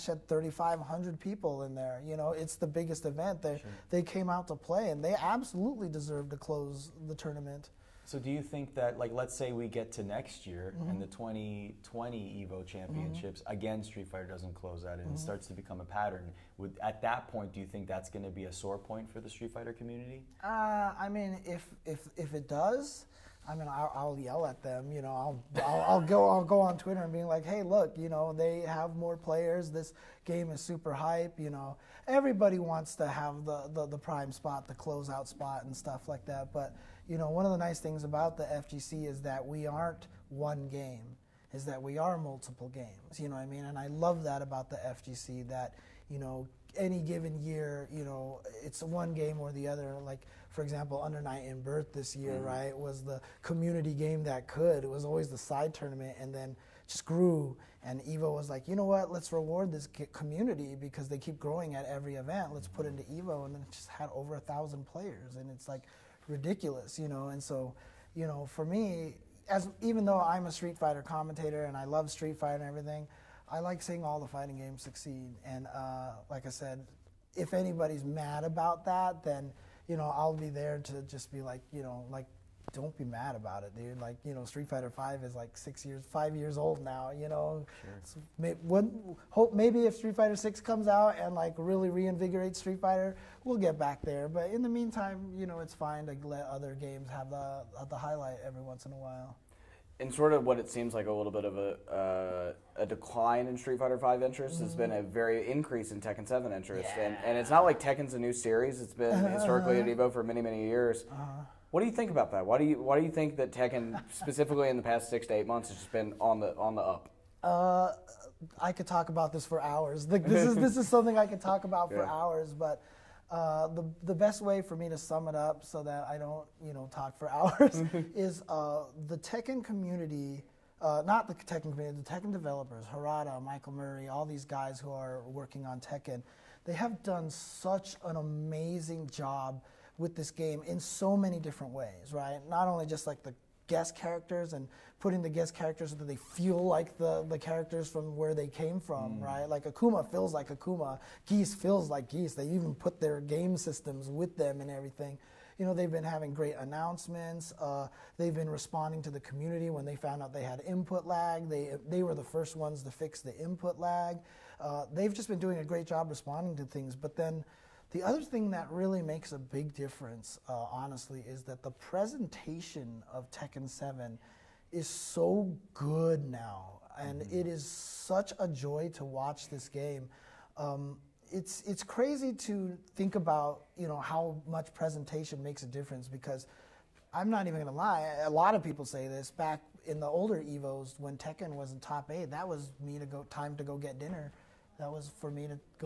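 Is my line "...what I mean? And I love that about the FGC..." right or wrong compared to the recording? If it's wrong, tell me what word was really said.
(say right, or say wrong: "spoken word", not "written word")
right.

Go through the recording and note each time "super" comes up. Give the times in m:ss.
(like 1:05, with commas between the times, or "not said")
0:30.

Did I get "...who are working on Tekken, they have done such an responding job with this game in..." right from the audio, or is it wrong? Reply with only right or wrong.
wrong.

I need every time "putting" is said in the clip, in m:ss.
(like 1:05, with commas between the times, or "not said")
2:24.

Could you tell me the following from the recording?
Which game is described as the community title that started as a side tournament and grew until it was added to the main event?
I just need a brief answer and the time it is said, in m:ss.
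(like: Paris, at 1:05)
Under Night in Birth, at 0:51.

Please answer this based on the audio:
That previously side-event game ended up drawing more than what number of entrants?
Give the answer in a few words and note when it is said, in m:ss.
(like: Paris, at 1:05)
1,000, at 1:04.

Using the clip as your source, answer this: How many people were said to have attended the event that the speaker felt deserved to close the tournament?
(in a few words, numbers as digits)
3,500.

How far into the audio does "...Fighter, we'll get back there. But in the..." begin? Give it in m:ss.
1:32.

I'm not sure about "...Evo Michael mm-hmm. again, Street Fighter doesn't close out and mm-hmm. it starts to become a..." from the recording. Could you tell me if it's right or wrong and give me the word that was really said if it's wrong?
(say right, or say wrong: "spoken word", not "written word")
wrong: "Championships", not "Michael".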